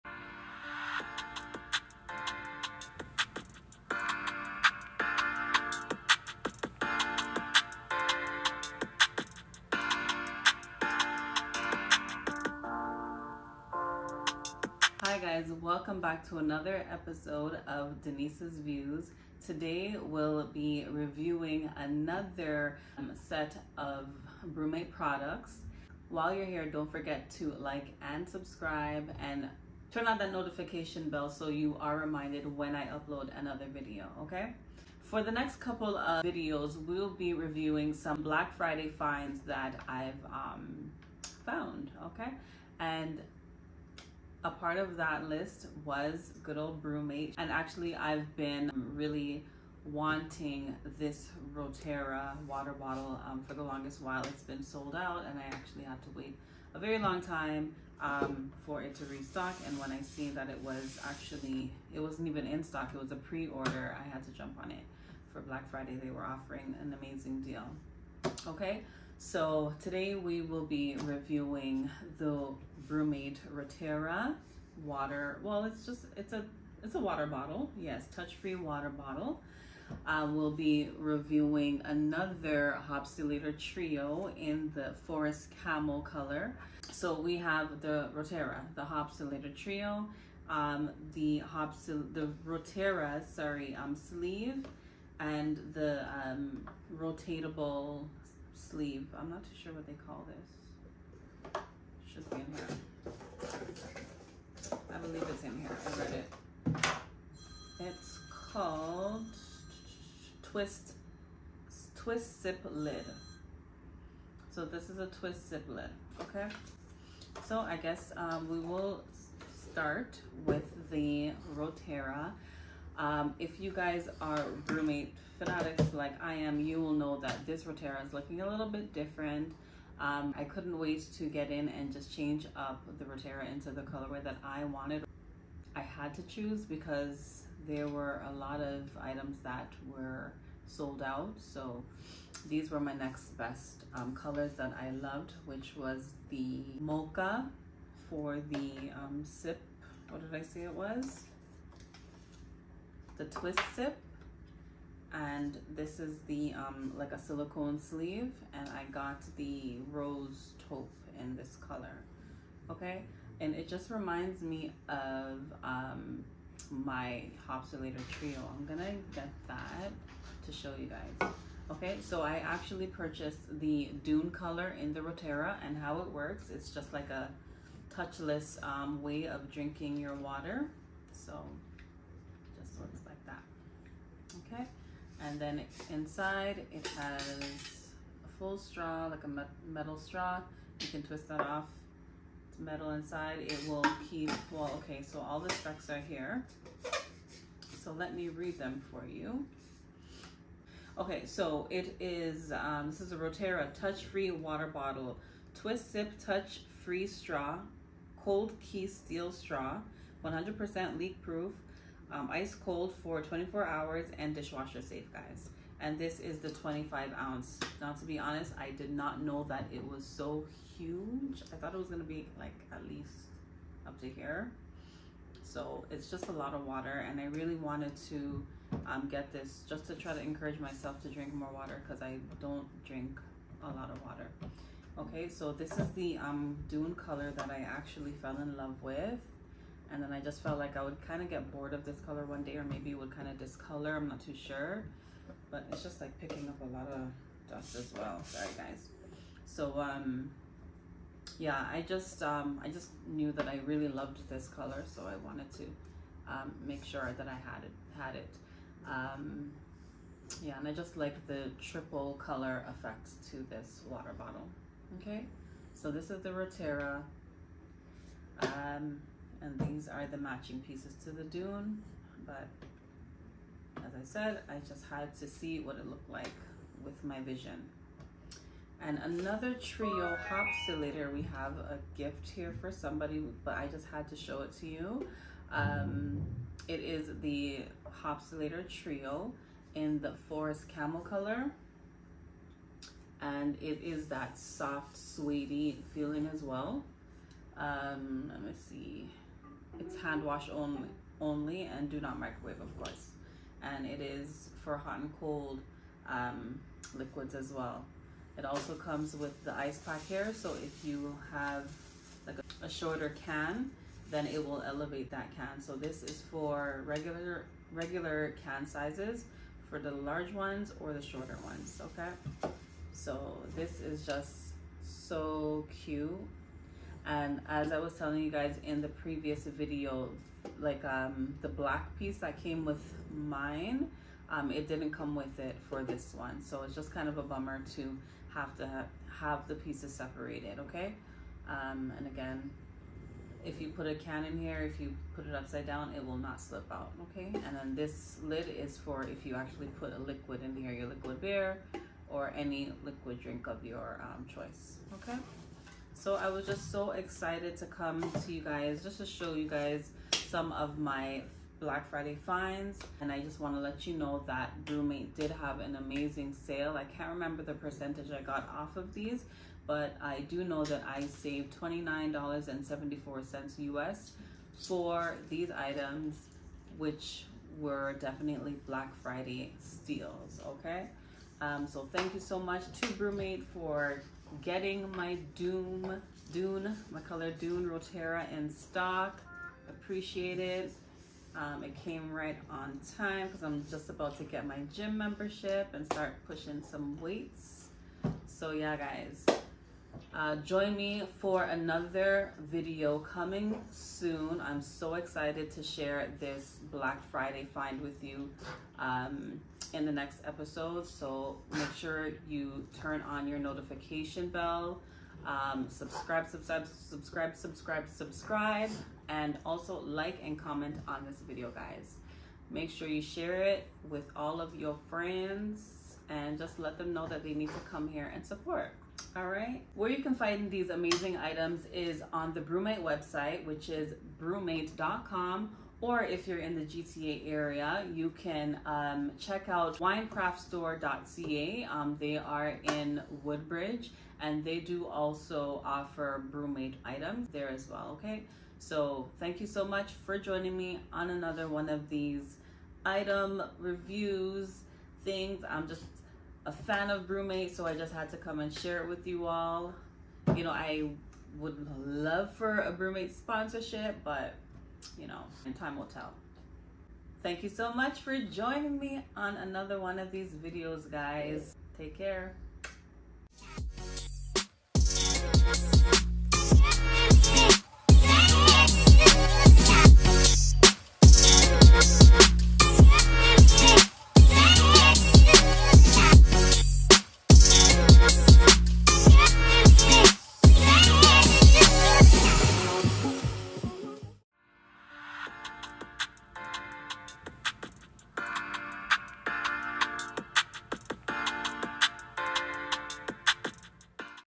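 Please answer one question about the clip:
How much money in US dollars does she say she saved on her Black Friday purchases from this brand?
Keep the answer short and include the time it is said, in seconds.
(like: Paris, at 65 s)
$29.74, at 371 s.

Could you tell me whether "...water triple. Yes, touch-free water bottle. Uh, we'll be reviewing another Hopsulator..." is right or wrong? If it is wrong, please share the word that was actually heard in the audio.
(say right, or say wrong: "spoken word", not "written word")
wrong: "bottle", not "triple".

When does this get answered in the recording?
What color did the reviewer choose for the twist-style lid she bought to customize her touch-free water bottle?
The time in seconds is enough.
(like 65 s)
146 s.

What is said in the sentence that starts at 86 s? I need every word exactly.
So we have the Rotera, the Hopsulator Trio, um, the Hopsil the Rotera, sorry, um, sleeve, and the um, rotatable sleeve.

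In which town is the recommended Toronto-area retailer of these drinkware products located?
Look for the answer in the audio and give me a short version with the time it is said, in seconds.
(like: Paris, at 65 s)
Woodbridge, at 443 s.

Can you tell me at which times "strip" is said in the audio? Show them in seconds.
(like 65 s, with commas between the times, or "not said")
not said.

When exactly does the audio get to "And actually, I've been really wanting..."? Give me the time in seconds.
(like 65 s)
47 s.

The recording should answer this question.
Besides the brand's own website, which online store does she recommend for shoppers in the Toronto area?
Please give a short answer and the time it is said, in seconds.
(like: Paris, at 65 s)
winecraftstore.ca, at 439 s.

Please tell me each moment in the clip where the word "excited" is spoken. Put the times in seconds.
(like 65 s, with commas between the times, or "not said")
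356 s, 404 s.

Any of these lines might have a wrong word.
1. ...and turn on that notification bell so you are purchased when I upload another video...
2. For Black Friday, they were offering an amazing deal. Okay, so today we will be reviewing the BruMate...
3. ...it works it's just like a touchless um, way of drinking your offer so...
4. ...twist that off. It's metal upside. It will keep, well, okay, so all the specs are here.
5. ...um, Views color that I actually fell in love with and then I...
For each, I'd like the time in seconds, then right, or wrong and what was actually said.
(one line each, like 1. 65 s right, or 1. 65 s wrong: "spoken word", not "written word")
1. 29 s wrong: "reminded", not "purchased"
2. 65 s right
3. 175 s wrong: "water", not "offer"
4. 191 s wrong: "inside", not "upside"
5. 236 s wrong: "Dune", not "Views".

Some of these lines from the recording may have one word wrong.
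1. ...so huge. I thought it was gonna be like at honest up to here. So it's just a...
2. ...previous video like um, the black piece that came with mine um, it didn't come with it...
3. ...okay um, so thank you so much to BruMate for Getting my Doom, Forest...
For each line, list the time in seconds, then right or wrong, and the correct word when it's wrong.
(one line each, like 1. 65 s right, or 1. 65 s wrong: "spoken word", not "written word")
1. 220 s wrong: "least", not "honest"
2. 328 s right
3. 380 s wrong: "Dune", not "Forest".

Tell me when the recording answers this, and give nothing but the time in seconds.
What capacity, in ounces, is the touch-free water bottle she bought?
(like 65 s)
216 s.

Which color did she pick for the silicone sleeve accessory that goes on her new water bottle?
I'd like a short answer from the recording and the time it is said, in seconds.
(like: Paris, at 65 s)
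rose taupe, at 159 s.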